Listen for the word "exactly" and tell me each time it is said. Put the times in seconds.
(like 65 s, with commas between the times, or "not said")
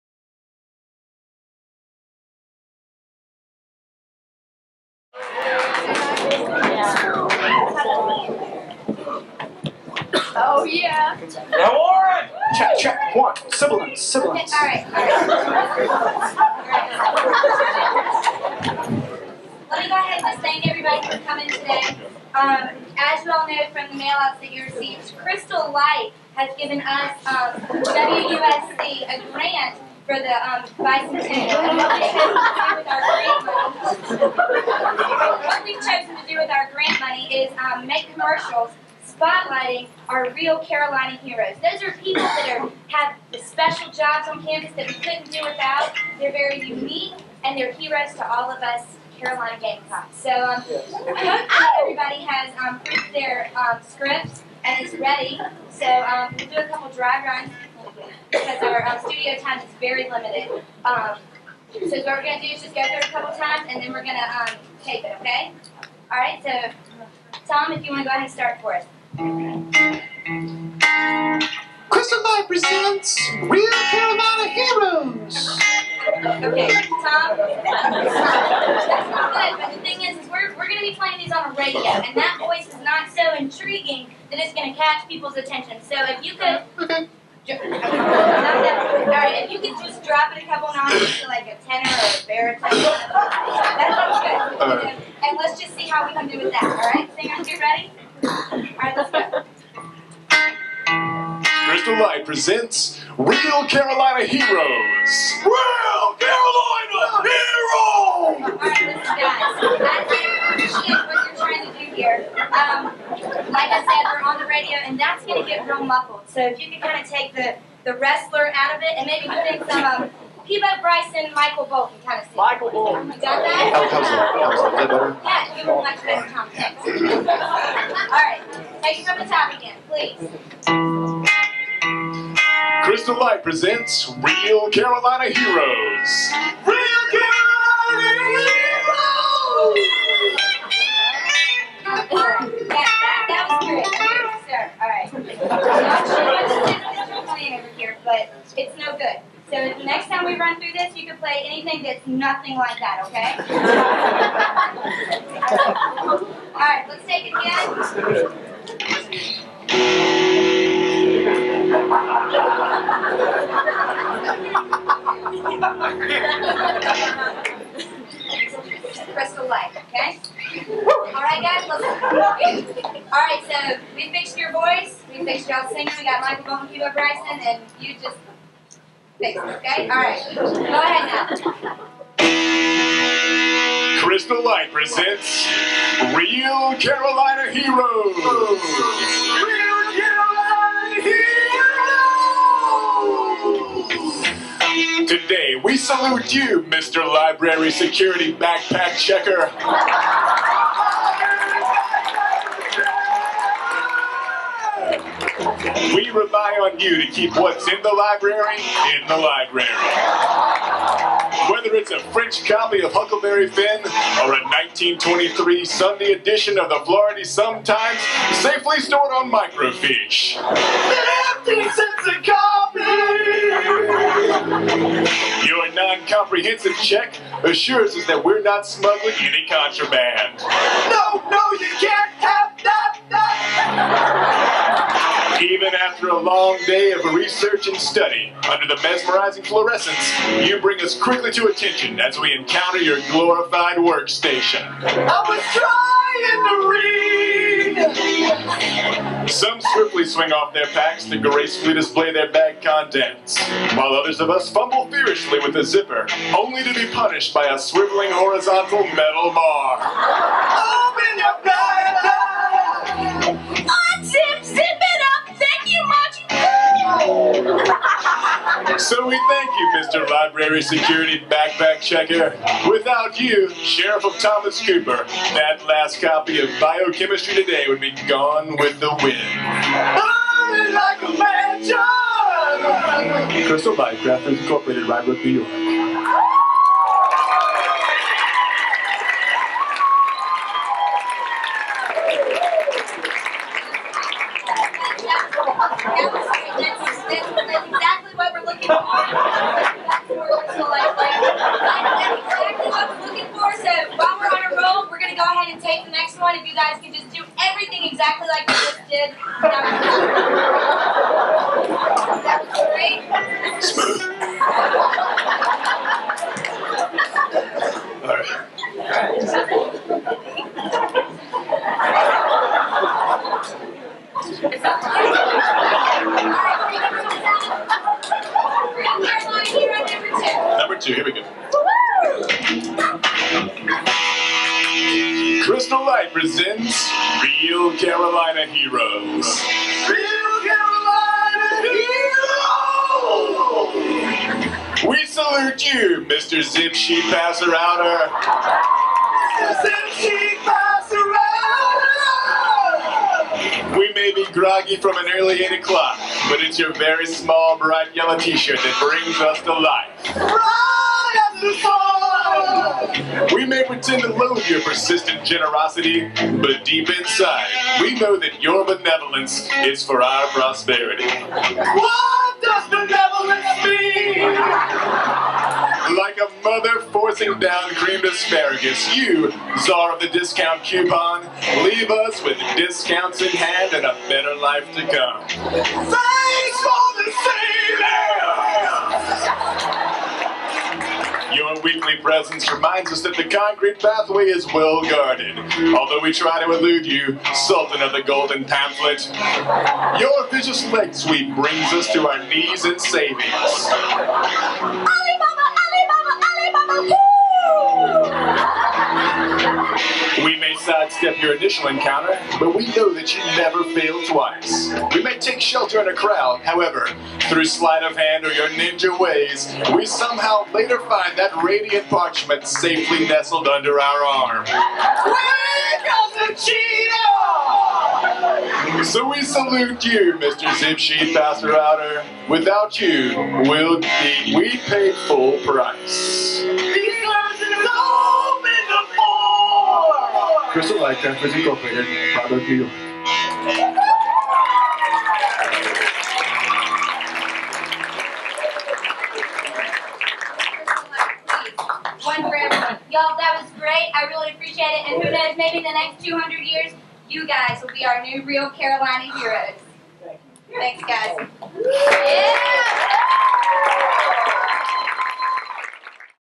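297 s, 307 s.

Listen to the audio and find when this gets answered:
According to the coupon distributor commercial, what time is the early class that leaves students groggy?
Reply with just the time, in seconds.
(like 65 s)
355 s.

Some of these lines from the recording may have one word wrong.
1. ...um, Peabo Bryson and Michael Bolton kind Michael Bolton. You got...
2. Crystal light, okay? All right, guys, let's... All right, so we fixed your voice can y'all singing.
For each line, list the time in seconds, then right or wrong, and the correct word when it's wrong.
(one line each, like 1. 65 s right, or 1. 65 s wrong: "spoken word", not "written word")
1. 120 s right
2. 169 s right.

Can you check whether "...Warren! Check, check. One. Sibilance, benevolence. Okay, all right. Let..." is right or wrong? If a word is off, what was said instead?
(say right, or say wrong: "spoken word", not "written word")
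wrong: "sibilance", not "benevolence".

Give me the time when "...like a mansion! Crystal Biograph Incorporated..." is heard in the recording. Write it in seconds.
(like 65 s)
281 s.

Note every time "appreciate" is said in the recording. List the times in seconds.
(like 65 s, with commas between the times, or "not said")
110 s, 454 s.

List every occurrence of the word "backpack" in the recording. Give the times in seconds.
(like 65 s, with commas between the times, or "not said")
198 s, 271 s.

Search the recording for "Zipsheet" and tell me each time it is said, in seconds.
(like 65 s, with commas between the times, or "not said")
430 s.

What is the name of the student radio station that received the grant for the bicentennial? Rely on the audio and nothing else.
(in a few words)
WUSC.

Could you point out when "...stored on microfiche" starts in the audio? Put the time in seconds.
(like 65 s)
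218 s.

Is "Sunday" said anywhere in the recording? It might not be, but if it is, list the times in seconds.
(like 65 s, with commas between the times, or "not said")
215 s.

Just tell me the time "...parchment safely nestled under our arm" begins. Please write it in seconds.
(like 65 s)
421 s.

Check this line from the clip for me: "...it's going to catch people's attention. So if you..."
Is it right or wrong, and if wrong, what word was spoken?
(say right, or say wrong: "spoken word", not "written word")
right.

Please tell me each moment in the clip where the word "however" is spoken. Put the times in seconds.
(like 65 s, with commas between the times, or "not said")
416 s.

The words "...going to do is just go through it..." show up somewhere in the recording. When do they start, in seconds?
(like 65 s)
62 s.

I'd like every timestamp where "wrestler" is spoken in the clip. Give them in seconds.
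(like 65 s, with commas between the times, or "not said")
117 s.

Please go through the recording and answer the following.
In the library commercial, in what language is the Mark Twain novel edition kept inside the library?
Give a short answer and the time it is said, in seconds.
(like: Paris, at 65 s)
French, at 212 s.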